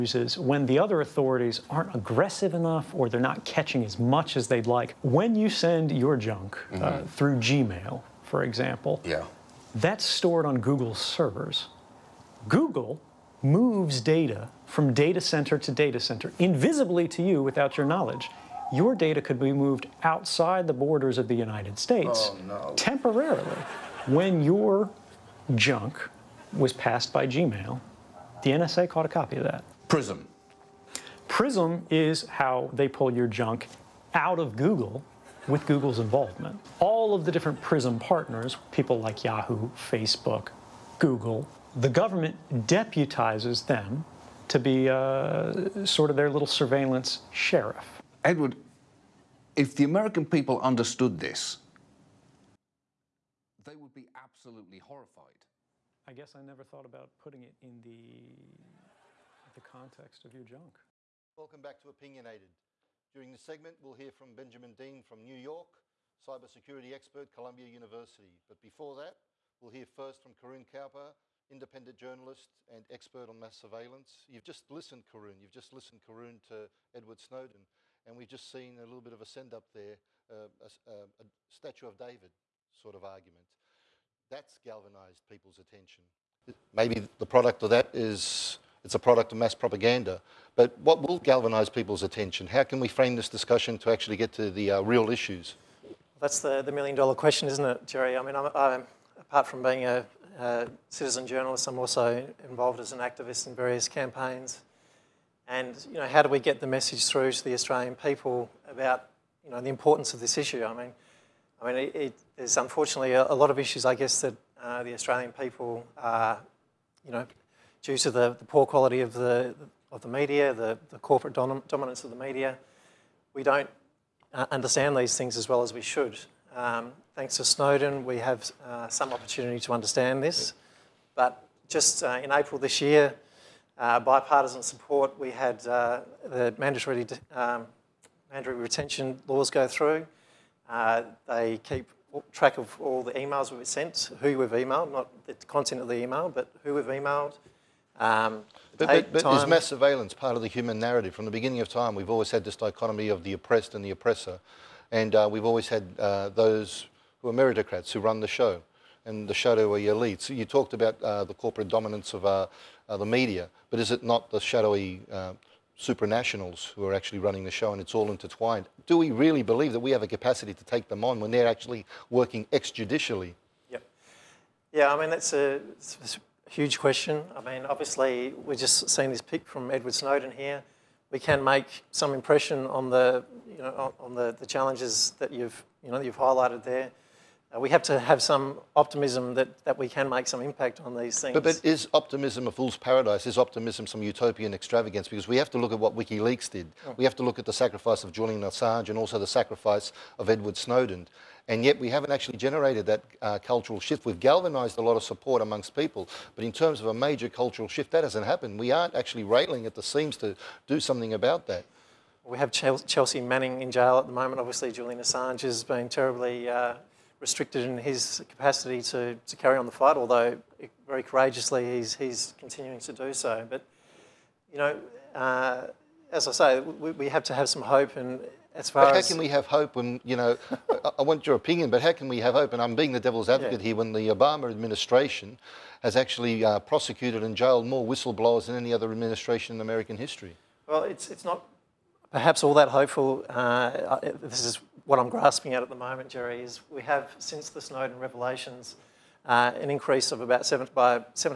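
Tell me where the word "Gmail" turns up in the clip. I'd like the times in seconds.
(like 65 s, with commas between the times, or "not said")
7 s, 27 s.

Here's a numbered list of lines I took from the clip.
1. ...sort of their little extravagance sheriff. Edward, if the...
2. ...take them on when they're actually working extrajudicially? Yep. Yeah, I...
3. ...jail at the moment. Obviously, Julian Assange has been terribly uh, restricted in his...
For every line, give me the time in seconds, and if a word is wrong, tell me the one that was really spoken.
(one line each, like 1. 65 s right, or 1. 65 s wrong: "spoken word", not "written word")
1. 45 s wrong: "surveillance", not "extravagance"
2. 170 s right
3. 213 s right.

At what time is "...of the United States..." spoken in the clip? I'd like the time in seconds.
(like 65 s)
21 s.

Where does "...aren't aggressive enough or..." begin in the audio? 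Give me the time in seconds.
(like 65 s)
1 s.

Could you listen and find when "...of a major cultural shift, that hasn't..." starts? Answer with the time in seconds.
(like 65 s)
206 s.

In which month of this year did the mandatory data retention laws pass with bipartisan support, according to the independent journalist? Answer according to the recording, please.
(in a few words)
April.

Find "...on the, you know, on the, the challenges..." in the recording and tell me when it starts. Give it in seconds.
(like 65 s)
182 s.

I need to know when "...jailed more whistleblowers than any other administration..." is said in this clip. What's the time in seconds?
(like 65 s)
237 s.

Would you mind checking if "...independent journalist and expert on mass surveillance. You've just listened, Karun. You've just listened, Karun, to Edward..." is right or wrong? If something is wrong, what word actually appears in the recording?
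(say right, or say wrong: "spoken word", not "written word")
right.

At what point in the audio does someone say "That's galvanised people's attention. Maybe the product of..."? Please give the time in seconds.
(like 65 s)
84 s.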